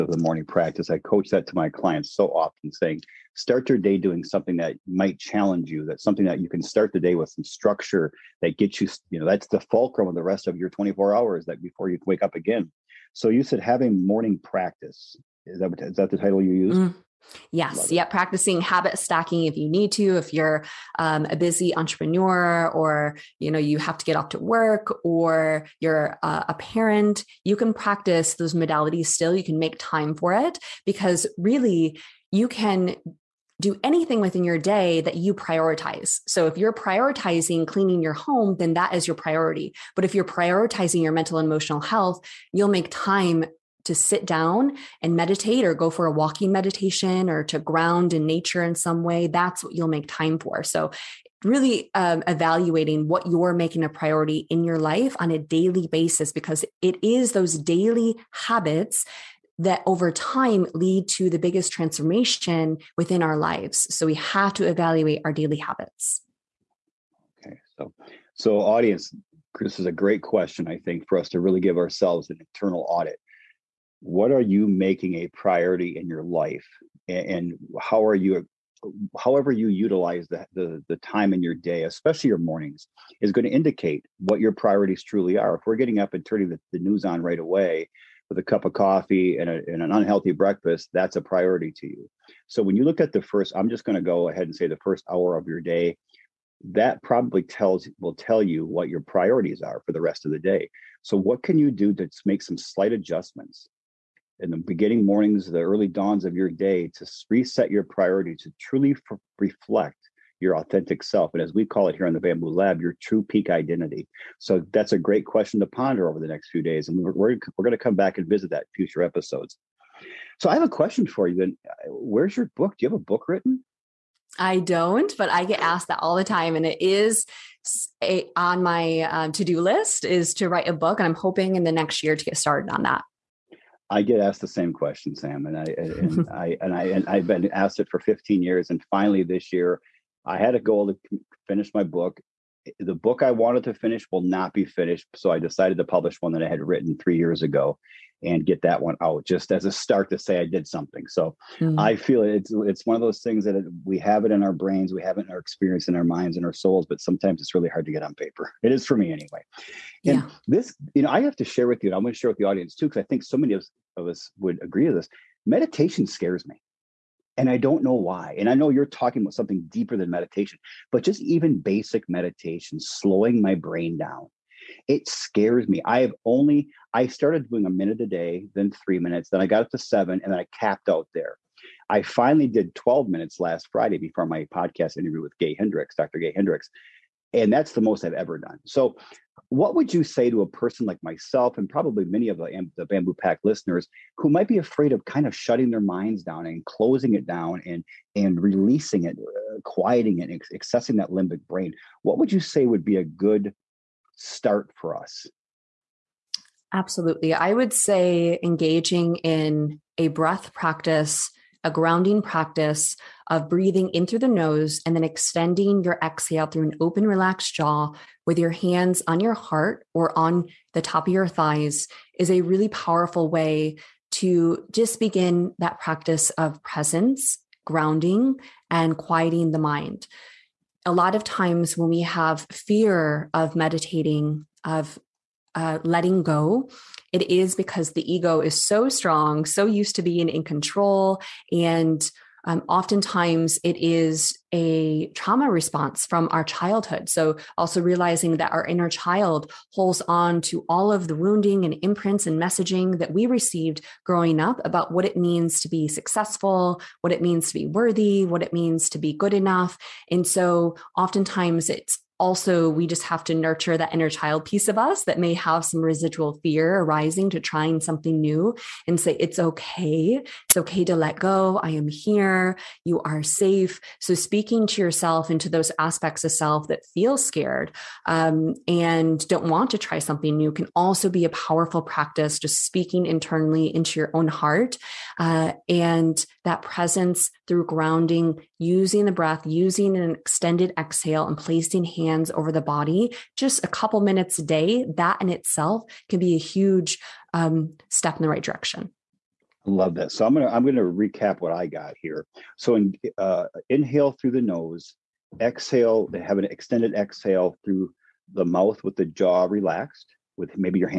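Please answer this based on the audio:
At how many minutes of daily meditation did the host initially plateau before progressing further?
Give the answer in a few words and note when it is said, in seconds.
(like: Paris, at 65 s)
7, at 179 s.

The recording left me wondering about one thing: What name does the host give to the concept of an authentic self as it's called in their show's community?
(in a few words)
true peak identity.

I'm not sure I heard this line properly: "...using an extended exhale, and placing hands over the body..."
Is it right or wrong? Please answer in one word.
right.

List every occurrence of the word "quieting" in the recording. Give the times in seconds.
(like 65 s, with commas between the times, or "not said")
199 s, 228 s.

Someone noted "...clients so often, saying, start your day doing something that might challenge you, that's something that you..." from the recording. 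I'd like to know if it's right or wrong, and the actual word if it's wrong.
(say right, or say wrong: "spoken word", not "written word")
right.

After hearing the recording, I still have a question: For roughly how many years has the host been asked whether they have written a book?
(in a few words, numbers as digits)
15.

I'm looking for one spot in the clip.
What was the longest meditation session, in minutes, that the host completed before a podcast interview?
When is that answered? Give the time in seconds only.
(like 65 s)
182 s.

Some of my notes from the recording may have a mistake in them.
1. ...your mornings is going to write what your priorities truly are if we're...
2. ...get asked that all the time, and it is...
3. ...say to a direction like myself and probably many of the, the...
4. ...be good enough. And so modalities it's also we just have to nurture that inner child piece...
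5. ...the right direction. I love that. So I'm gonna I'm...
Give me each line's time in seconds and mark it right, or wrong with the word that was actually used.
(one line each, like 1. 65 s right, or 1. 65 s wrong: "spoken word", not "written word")
1. 82 s wrong: "indicate", not "write"
2. 125 s right
3. 190 s wrong: "person", not "direction"
4. 258 s wrong: "oftentimes", not "modalities"
5. 298 s right.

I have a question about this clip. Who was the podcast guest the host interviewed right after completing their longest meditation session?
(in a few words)
Dr. Gay Hendricks.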